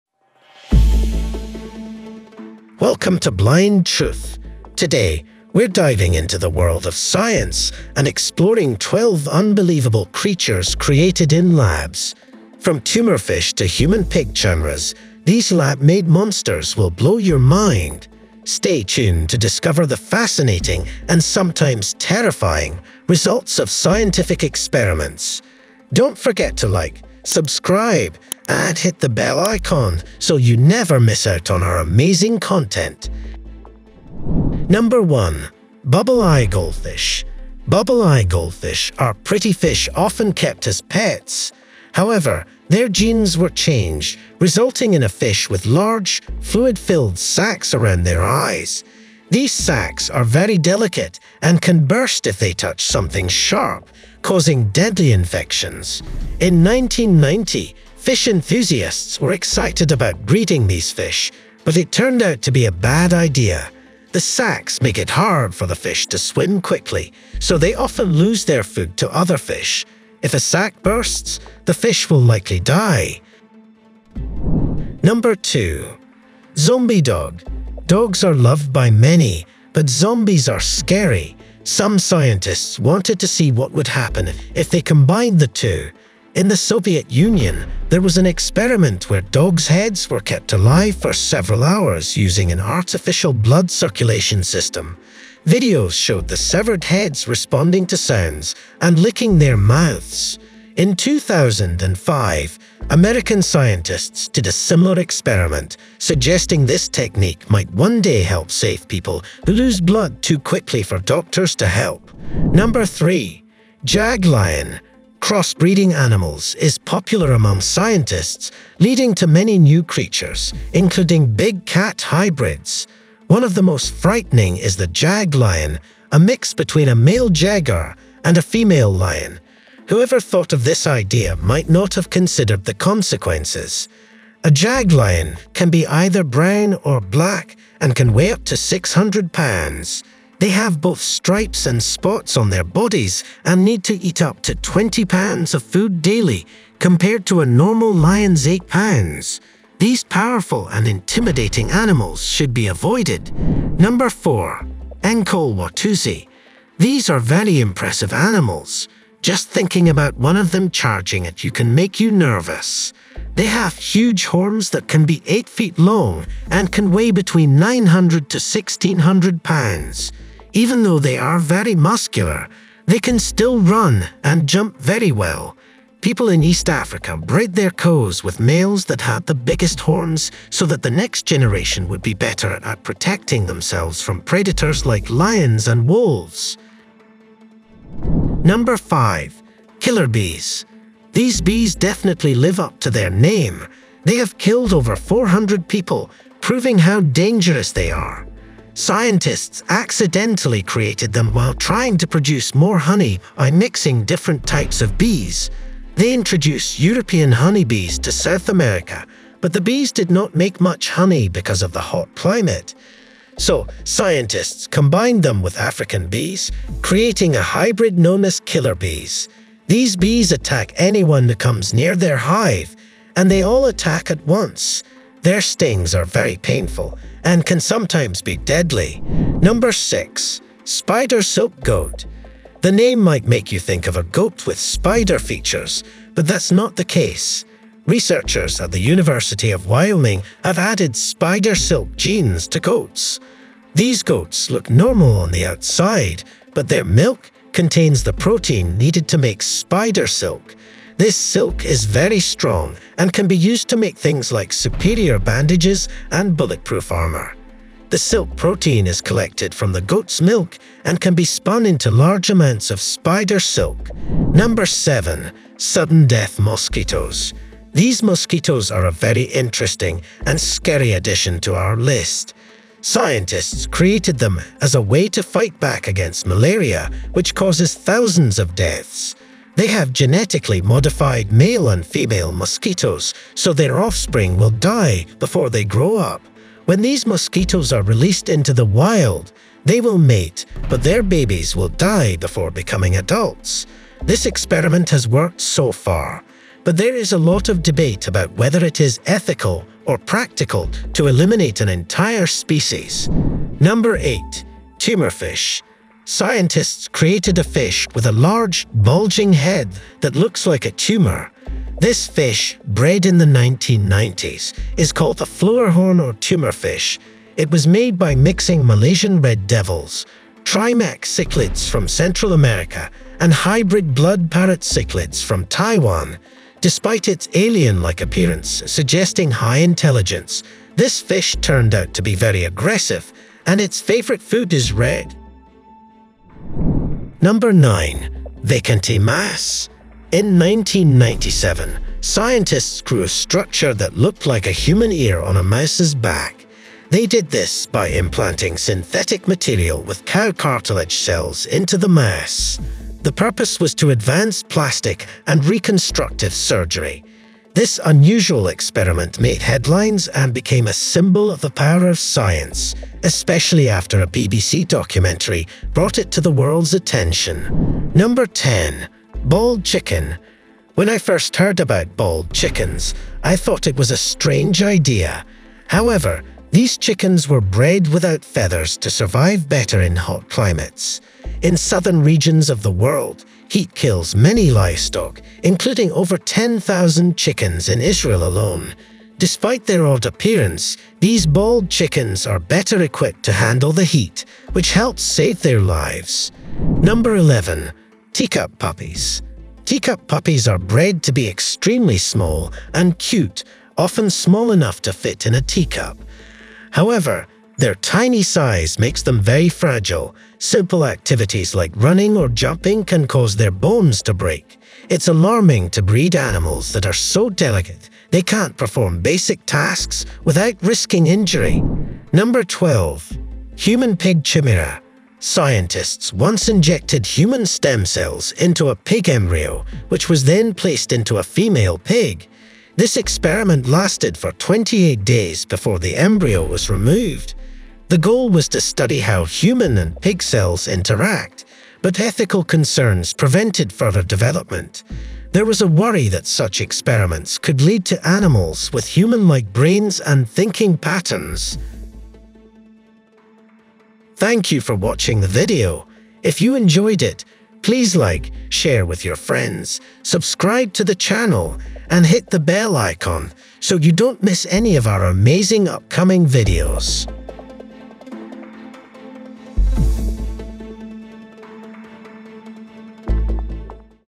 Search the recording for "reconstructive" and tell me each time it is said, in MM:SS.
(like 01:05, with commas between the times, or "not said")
05:55.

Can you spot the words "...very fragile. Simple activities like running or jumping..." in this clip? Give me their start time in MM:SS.
06:49.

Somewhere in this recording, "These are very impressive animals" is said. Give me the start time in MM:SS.
02:36.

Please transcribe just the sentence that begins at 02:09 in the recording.
Whoever thought of this idea might not have considered the consequences.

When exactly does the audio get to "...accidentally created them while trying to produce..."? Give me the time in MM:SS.
03:19.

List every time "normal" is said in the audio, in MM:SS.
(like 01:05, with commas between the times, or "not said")
02:27, 04:04.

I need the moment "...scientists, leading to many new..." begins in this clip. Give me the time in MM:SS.
01:57.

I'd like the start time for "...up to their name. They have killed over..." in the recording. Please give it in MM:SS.
03:12.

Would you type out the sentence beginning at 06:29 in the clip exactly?
Despite their odd appearance, these bald chickens are better equipped to handle the heat, which helps save their lives.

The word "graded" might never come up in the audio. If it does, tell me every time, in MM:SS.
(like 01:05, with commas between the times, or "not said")
not said.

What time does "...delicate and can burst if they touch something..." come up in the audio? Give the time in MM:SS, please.
00:50.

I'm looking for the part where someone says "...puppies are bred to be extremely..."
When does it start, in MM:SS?
06:40.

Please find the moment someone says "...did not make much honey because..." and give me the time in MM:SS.
03:29.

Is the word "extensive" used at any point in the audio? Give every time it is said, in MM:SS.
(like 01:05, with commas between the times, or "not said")
not said.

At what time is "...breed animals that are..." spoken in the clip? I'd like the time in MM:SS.
06:55.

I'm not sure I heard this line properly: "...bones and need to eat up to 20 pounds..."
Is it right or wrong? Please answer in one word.
wrong.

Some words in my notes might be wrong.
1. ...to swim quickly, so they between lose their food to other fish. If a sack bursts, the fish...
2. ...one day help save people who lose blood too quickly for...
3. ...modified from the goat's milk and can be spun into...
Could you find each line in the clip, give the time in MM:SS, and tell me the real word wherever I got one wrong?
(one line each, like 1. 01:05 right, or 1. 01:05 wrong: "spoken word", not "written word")
1. 01:06 wrong: "often", not "between"
2. 01:47 right
3. 04:19 wrong: "collected", not "modified".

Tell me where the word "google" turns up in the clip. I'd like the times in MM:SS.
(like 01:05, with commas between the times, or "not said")
not said.